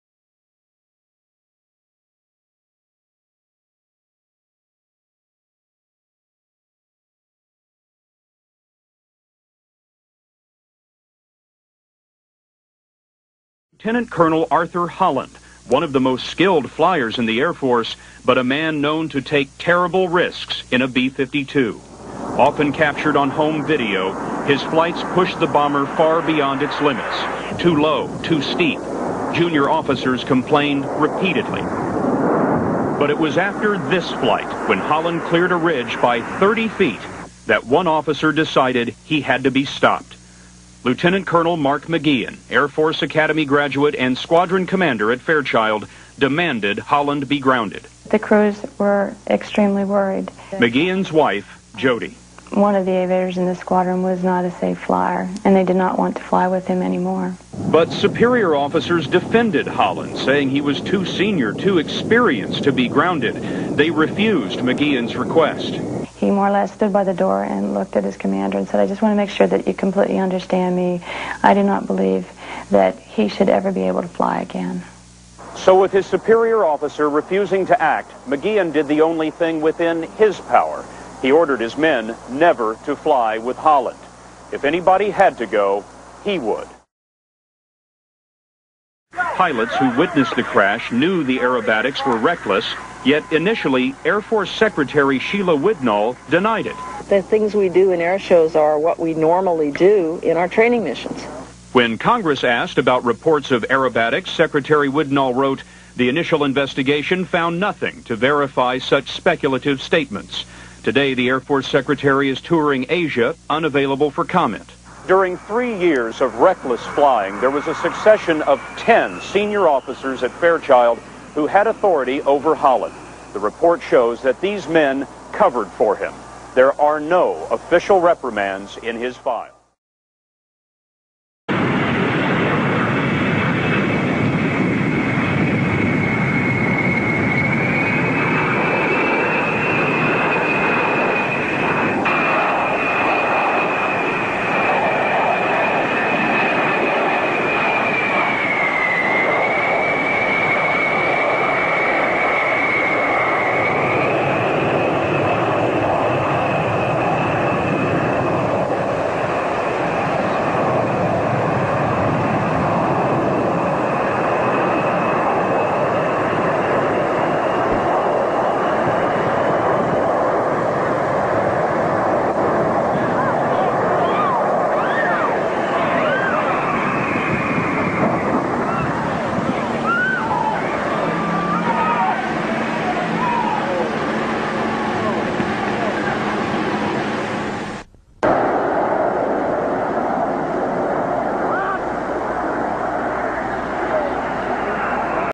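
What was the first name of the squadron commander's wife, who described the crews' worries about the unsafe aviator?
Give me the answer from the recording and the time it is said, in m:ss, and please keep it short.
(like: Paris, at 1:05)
Jody, at 0:51.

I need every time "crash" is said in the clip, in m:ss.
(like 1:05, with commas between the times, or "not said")
1:30.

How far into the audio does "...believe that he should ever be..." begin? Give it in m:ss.
1:11.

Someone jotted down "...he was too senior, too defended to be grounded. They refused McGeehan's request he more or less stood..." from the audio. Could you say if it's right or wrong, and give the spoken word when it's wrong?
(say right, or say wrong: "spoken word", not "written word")
wrong: "experienced", not "defended".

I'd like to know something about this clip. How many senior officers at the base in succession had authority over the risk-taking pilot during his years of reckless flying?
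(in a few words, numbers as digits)
10.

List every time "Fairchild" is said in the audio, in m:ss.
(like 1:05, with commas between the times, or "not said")
0:45, 2:00.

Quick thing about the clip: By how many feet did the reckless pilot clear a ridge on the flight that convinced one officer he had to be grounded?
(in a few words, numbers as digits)
30 feet.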